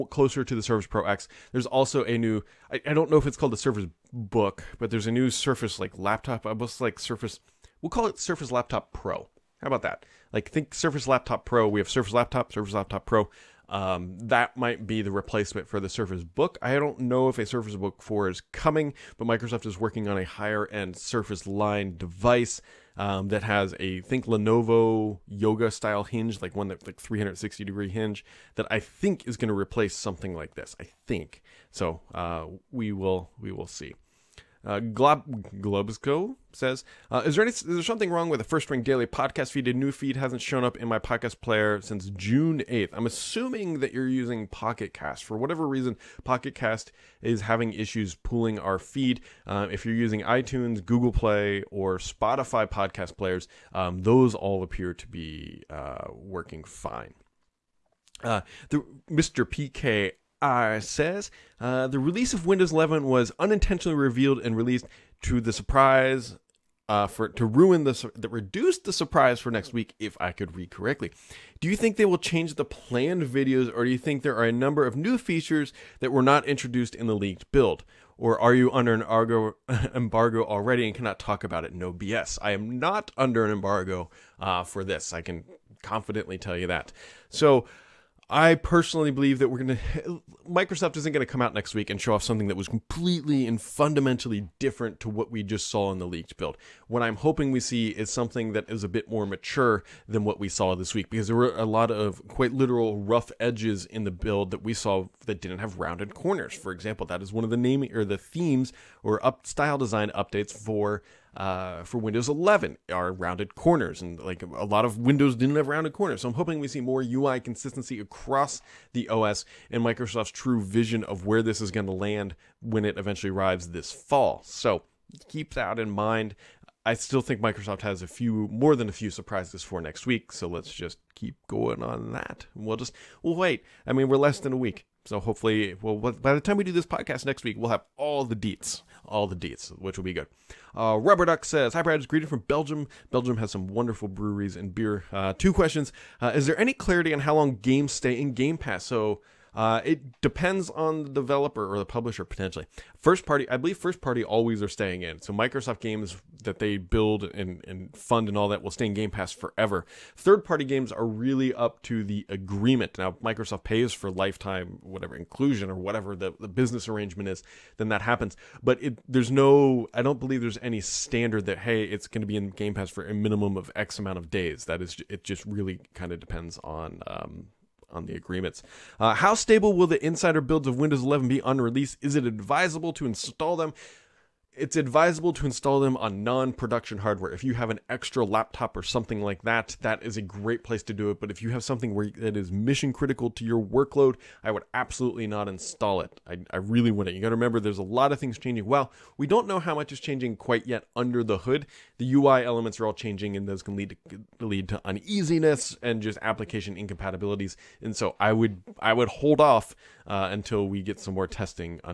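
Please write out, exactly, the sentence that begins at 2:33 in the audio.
First party, I believe first party always are staying in.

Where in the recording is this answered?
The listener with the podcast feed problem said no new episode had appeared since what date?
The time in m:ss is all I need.
0:42.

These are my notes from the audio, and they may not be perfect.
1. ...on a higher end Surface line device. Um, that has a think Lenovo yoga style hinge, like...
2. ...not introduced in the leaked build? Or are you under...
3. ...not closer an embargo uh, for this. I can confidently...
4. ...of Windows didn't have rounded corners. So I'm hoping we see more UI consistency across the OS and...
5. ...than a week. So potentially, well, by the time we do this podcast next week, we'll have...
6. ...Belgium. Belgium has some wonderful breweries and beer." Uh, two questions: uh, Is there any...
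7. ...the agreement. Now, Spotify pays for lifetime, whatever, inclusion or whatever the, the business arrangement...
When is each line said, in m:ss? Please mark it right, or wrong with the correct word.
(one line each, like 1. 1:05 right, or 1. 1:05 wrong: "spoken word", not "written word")
1. 0:20 right
2. 1:16 right
3. 1:22 wrong: "under", not "closer"
4. 1:54 right
5. 2:14 wrong: "hopefully", not "potentially"
6. 2:22 right
7. 2:42 wrong: "Microsoft", not "Spotify".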